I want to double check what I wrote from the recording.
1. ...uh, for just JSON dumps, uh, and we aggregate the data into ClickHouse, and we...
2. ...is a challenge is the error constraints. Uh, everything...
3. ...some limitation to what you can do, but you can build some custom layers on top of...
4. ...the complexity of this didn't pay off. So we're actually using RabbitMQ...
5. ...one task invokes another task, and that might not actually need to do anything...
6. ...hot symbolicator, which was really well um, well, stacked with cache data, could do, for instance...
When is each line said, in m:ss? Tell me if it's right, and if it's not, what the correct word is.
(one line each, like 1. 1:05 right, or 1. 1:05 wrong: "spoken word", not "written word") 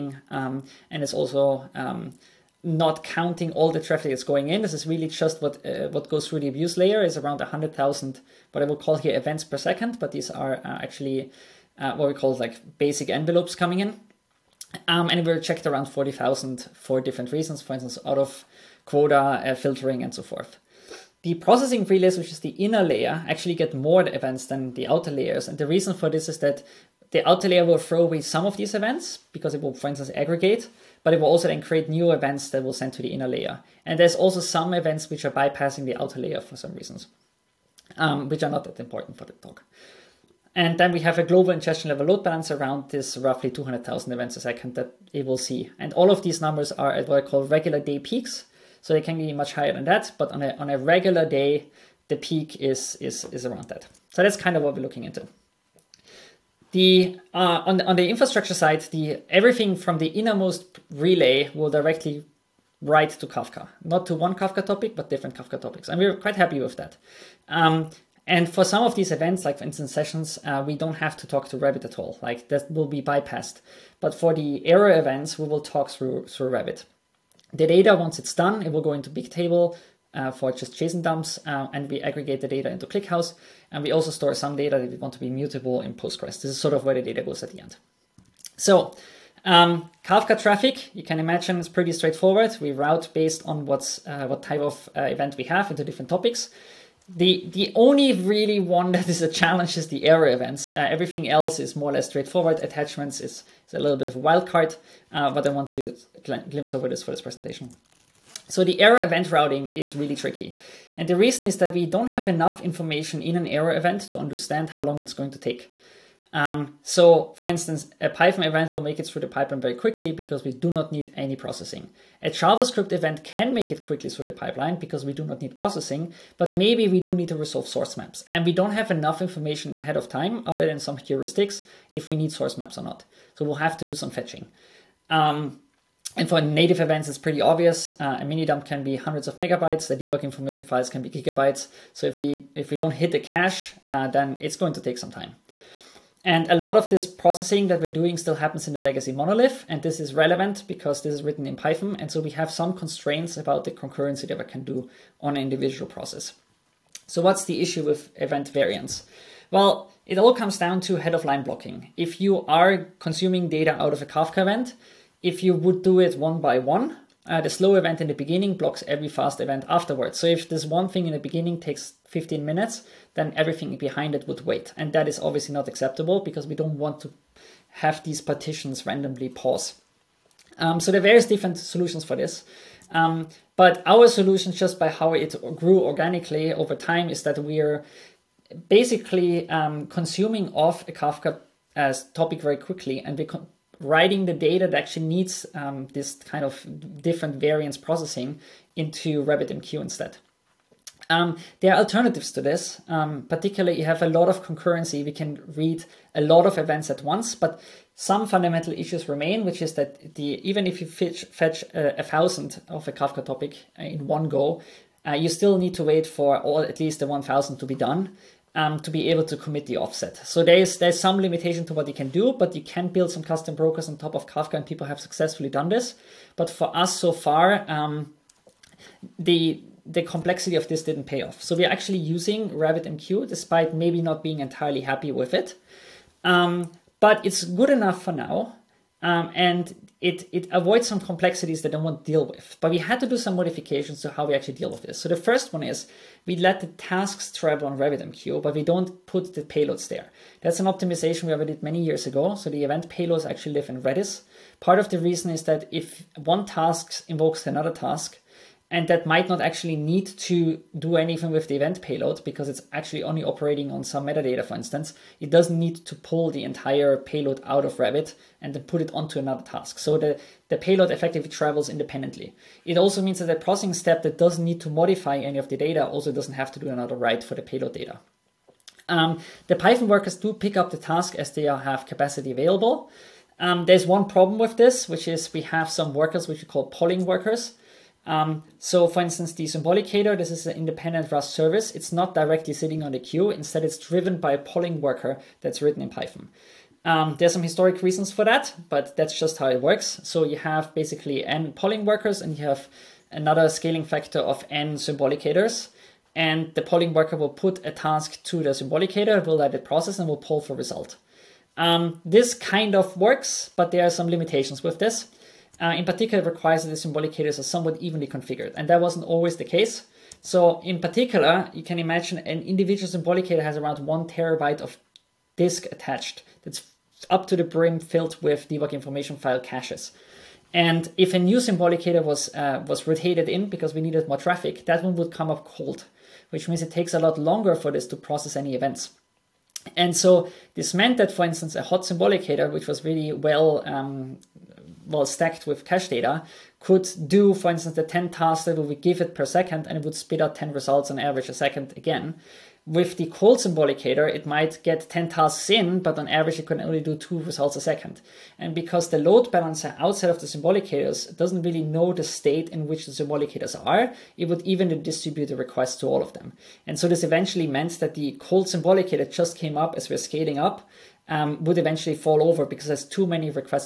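1. 1:20 right
2. 1:39 wrong: "events", not "constraints"
3. 3:40 wrong: "brokers", not "layers"
4. 3:49 right
5. 4:16 right
6. 5:41 right.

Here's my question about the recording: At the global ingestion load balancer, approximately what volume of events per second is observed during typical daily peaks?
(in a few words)
200,000.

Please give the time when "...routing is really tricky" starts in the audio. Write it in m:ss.
1:49.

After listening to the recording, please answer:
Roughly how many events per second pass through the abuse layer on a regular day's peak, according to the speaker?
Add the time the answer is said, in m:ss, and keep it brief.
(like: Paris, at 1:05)
100,000, at 0:07.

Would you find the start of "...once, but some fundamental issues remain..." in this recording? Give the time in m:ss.
3:27.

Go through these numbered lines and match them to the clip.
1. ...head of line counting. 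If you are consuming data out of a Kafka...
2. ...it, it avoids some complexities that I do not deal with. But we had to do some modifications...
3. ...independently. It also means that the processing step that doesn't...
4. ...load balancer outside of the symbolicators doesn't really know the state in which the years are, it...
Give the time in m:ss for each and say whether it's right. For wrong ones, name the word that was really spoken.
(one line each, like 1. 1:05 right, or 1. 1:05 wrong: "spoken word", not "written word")
1. 2:40 wrong: "blocking", not "counting"
2. 4:00 right
3. 4:31 right
4. 5:58 wrong: "symbolicators", not "years".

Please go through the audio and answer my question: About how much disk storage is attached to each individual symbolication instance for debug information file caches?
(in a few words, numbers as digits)
1 terabyte.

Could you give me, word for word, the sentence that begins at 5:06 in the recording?
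And the polling worker will put a task to the symbolicator, will let it process and will poll for result.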